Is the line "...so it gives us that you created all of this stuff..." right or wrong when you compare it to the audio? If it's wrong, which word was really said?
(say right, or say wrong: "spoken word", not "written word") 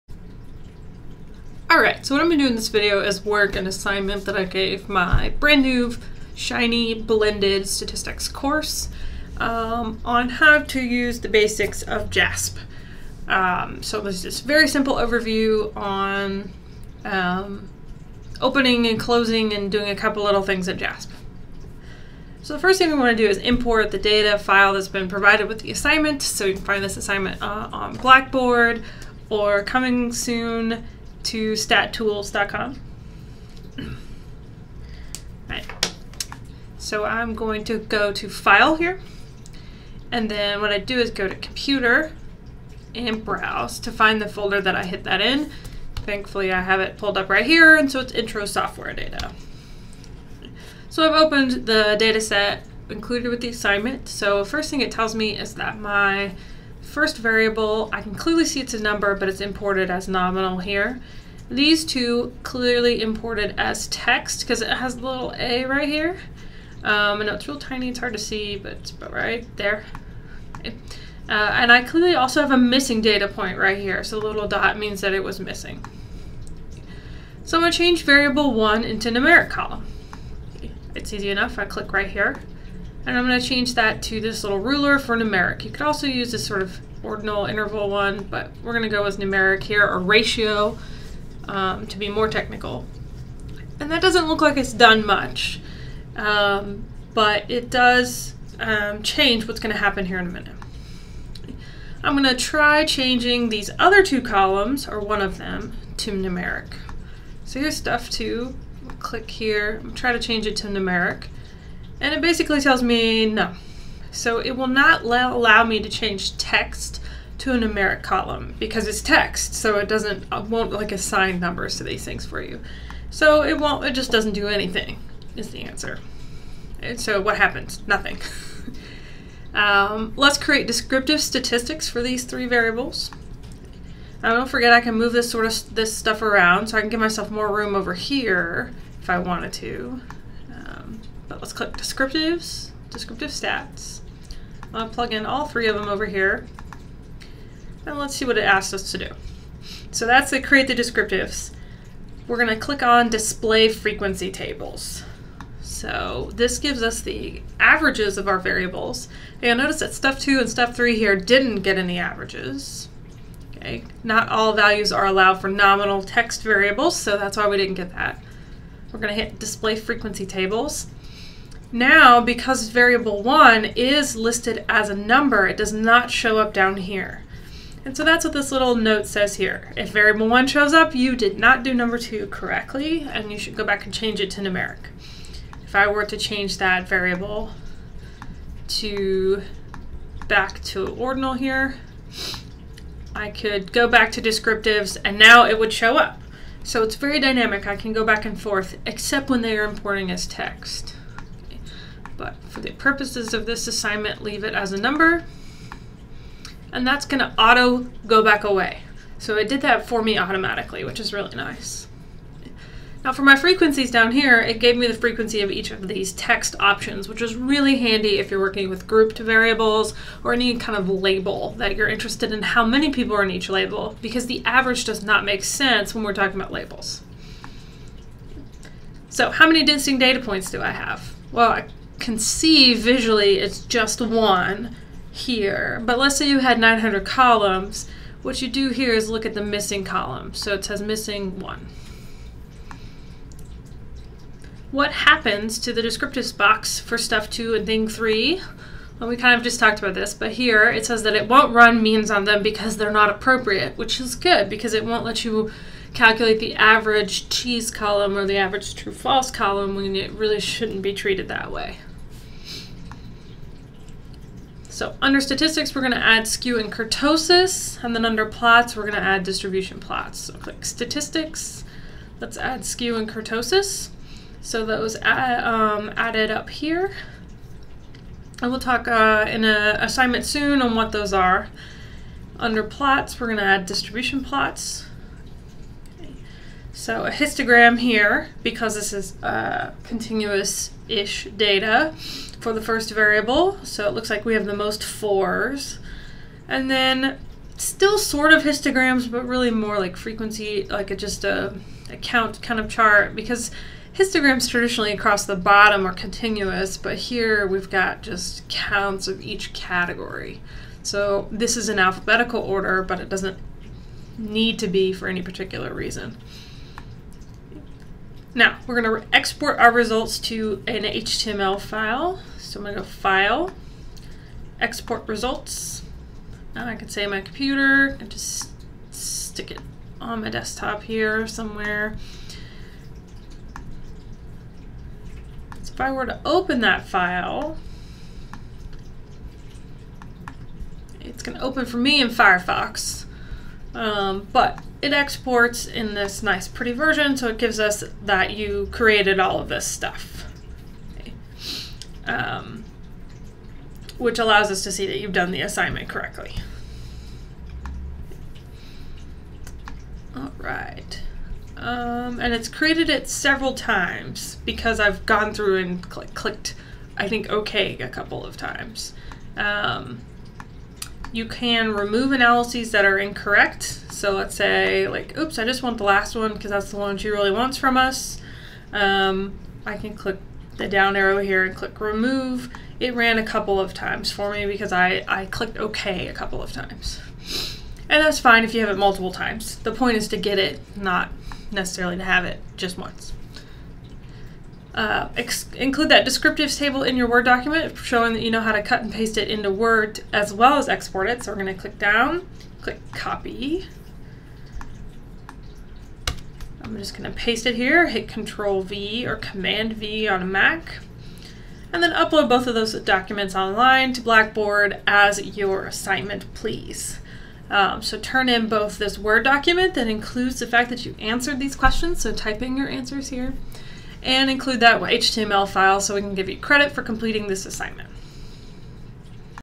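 right.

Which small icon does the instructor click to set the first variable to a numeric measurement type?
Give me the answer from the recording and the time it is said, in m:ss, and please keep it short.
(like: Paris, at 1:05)
little ruler, at 1:24.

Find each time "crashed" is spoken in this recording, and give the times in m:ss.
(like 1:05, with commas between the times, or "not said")
not said.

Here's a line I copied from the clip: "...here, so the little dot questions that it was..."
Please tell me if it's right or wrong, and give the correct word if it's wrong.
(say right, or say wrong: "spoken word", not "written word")
wrong: "means", not "questions".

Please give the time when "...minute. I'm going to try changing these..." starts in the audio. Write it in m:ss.
1:40.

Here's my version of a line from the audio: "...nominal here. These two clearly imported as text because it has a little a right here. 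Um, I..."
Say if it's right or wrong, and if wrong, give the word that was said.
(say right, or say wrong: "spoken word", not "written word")
right.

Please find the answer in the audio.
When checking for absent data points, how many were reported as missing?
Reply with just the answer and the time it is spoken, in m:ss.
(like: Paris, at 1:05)
1, at 4:00.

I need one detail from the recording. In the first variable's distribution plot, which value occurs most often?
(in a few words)
4.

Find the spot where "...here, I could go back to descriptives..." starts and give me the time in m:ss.
3:11.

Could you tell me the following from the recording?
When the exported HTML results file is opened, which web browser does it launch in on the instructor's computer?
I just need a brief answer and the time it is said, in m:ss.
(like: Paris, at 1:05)
Firefox, at 5:42.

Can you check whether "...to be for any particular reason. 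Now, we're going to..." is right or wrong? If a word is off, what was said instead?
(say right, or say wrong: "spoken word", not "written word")
right.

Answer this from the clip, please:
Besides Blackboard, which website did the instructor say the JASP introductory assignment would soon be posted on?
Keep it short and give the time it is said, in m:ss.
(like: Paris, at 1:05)
statstools.com, at 0:31.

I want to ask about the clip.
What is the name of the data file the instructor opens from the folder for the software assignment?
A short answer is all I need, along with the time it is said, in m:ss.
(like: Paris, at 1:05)
Intro Software Data, at 0:48.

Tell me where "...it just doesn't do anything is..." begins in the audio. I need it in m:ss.
2:03.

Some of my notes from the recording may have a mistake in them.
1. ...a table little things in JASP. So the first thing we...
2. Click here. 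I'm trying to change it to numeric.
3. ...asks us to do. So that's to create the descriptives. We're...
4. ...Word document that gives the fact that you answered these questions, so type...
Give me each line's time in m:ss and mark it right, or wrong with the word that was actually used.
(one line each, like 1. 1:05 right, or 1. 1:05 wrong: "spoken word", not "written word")
1. 0:19 wrong: "couple", not "table"
2. 1:48 right
3. 2:28 right
4. 6:58 wrong: "includes", not "gives".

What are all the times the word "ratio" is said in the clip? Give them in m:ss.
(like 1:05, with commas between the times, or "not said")
1:29.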